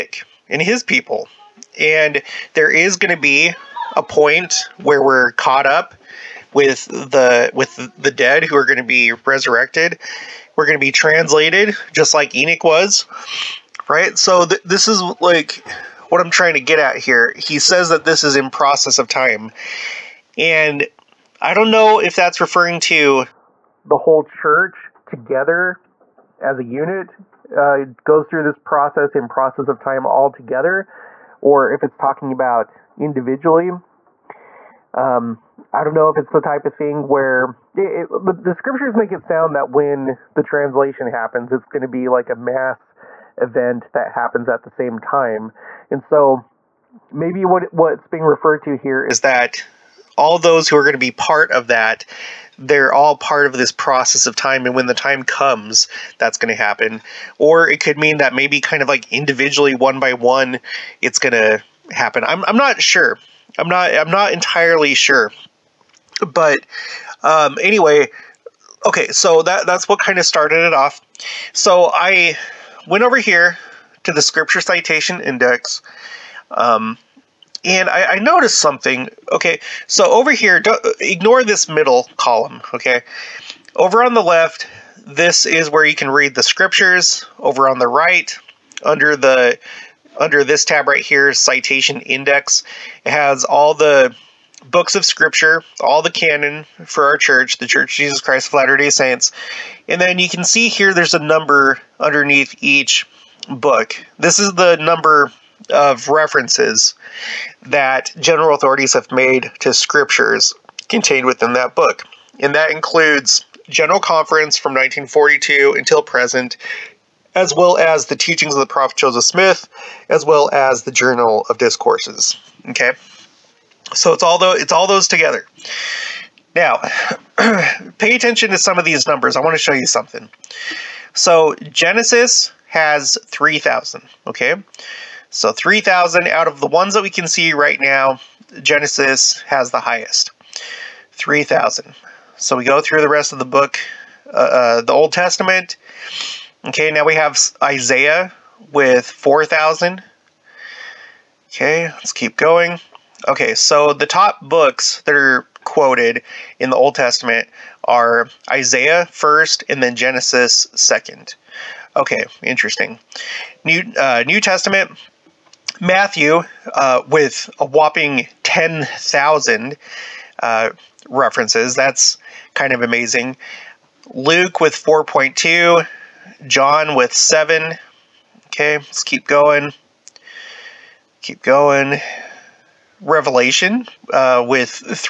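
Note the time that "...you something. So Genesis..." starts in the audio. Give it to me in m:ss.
2:09.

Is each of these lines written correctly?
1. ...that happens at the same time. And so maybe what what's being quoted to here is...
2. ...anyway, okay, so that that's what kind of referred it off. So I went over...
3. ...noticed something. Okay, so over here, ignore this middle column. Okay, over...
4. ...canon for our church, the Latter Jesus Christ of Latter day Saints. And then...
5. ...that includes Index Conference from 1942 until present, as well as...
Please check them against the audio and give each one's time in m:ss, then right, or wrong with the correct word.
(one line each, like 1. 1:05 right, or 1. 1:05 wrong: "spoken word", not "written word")
1. 0:43 wrong: "referred", not "quoted"
2. 1:07 wrong: "started", not "referred"
3. 1:18 right
4. 1:36 wrong: "Church", not "Latter"
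5. 1:52 wrong: "General", not "Index".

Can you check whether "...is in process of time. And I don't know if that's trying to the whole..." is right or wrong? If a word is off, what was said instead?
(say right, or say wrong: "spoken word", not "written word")
wrong: "referring", not "trying".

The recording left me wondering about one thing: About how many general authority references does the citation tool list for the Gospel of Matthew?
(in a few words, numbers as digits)
10,000.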